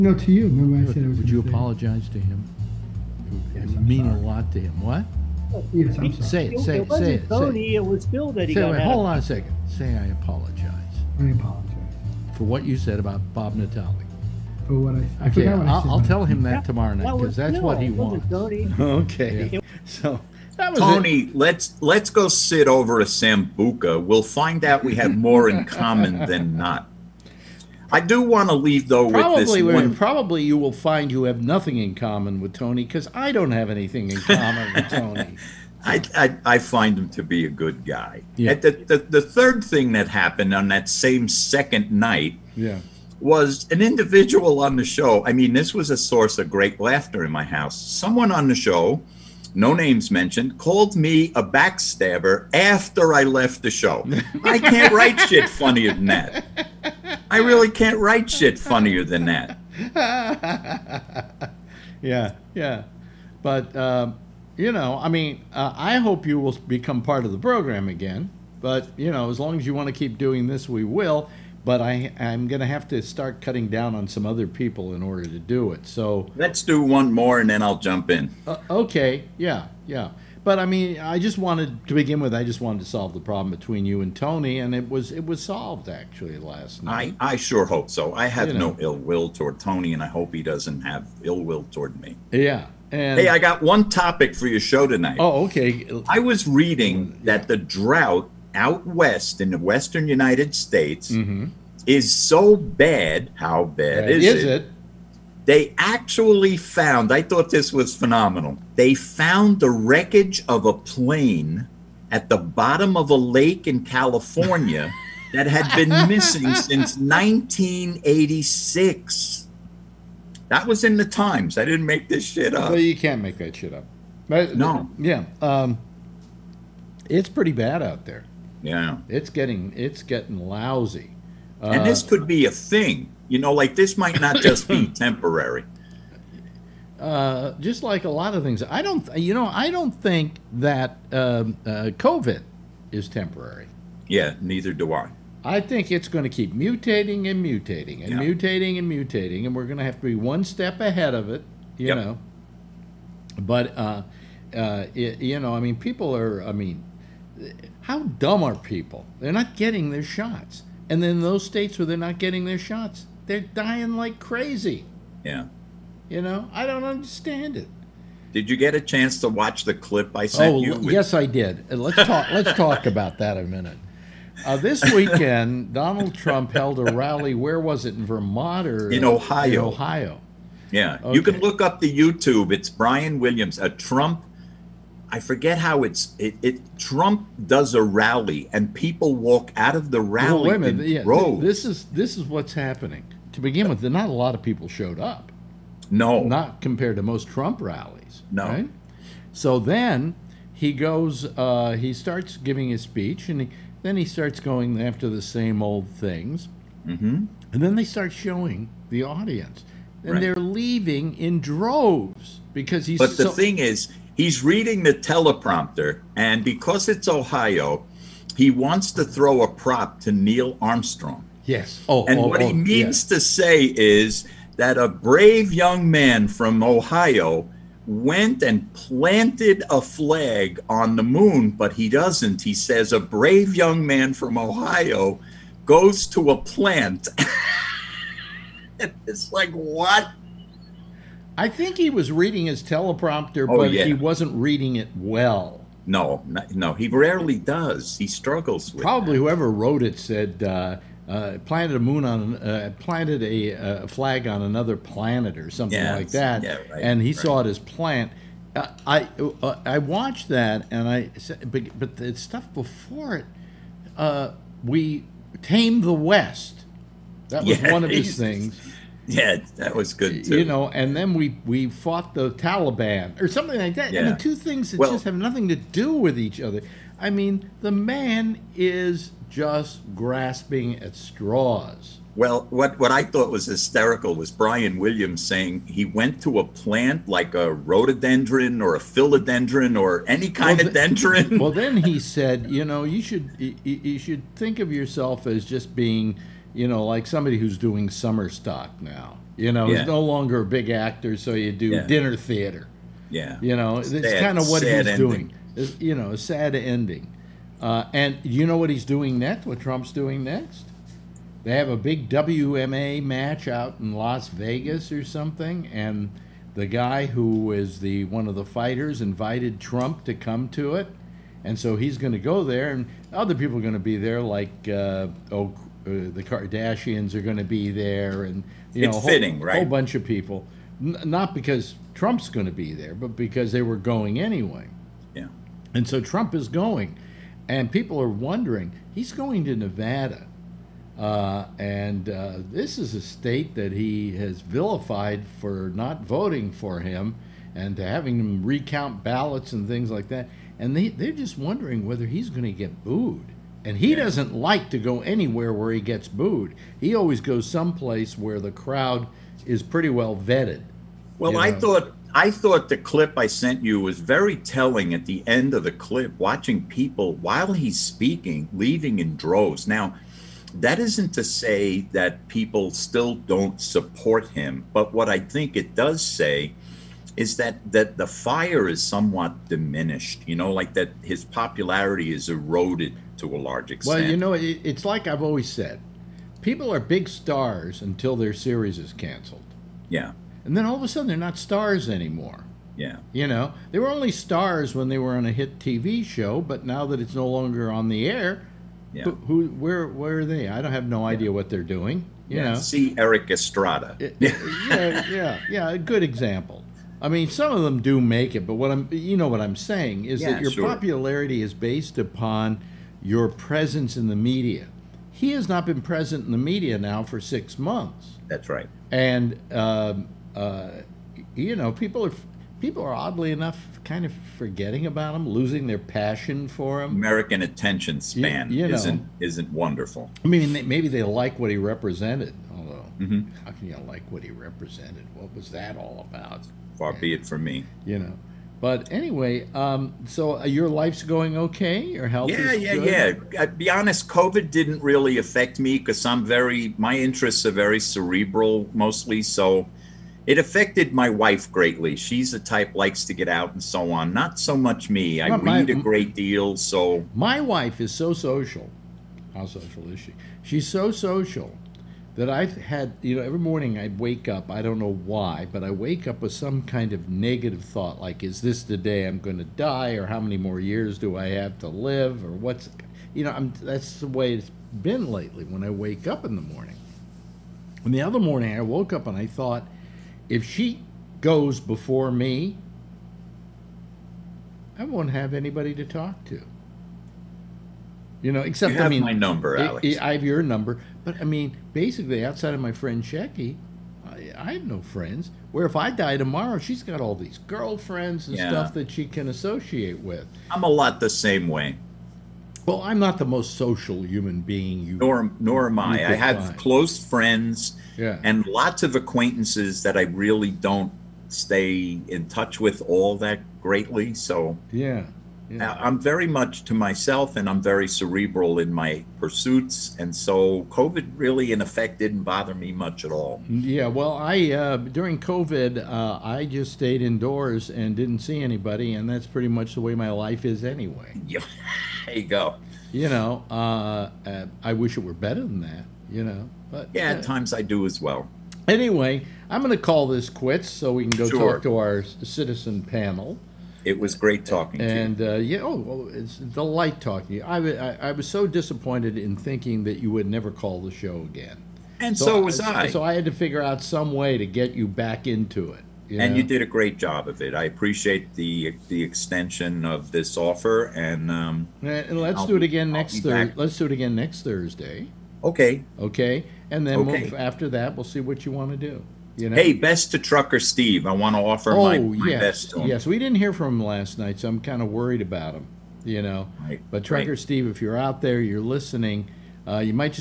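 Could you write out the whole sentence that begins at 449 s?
So it affected my wife greatly.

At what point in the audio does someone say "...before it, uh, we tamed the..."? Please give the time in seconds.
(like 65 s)
262 s.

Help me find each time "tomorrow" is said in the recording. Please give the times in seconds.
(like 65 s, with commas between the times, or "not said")
16 s, 496 s.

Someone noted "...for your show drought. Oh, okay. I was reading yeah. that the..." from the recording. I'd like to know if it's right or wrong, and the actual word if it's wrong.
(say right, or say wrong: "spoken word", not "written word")
wrong: "tonight", not "drought".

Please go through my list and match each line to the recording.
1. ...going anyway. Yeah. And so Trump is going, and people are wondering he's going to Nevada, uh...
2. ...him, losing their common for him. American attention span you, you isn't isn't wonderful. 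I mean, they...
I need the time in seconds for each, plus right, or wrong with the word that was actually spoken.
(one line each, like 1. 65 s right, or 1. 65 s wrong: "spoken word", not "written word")
1. 333 s right
2. 425 s wrong: "passion", not "common".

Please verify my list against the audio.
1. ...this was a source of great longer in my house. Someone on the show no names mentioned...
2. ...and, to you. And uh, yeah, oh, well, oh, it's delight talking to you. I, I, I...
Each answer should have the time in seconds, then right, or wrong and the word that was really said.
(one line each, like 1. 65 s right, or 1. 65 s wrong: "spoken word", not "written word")
1. 45 s wrong: "laughter", not "longer"
2. 544 s right.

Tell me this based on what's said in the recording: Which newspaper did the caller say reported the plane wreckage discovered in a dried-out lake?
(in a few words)
The Times.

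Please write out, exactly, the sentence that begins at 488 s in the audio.
You know, except you I mean, my number, Alex.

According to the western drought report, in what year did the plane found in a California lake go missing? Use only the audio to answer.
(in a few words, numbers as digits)
1986.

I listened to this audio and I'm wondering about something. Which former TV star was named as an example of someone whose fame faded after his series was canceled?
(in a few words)
Erik Estrada.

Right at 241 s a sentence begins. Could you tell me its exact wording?
I think he was reading his teleprompter, oh, but yeah.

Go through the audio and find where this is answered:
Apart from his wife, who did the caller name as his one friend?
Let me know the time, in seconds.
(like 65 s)
493 s.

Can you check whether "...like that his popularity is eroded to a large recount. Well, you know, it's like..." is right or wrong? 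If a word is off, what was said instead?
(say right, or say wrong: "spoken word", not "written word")
wrong: "extent", not "recount".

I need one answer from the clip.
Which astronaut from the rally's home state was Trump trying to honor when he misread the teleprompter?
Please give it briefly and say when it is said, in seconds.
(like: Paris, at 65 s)
Neil Armstrong, at 220 s.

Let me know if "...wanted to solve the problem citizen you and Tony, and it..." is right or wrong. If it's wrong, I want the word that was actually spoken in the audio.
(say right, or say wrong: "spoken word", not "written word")
wrong: "between", not "citizen".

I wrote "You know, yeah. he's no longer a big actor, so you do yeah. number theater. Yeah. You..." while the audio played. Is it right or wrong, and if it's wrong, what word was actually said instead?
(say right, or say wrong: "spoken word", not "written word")
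wrong: "dinner", not "number".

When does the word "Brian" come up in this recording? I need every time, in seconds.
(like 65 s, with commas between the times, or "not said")
182 s, 284 s.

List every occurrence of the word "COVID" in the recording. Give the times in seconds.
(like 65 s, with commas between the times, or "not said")
141 s, 444 s, 520 s, 525 s.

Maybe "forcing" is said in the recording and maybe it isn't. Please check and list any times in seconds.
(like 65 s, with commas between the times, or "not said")
not said.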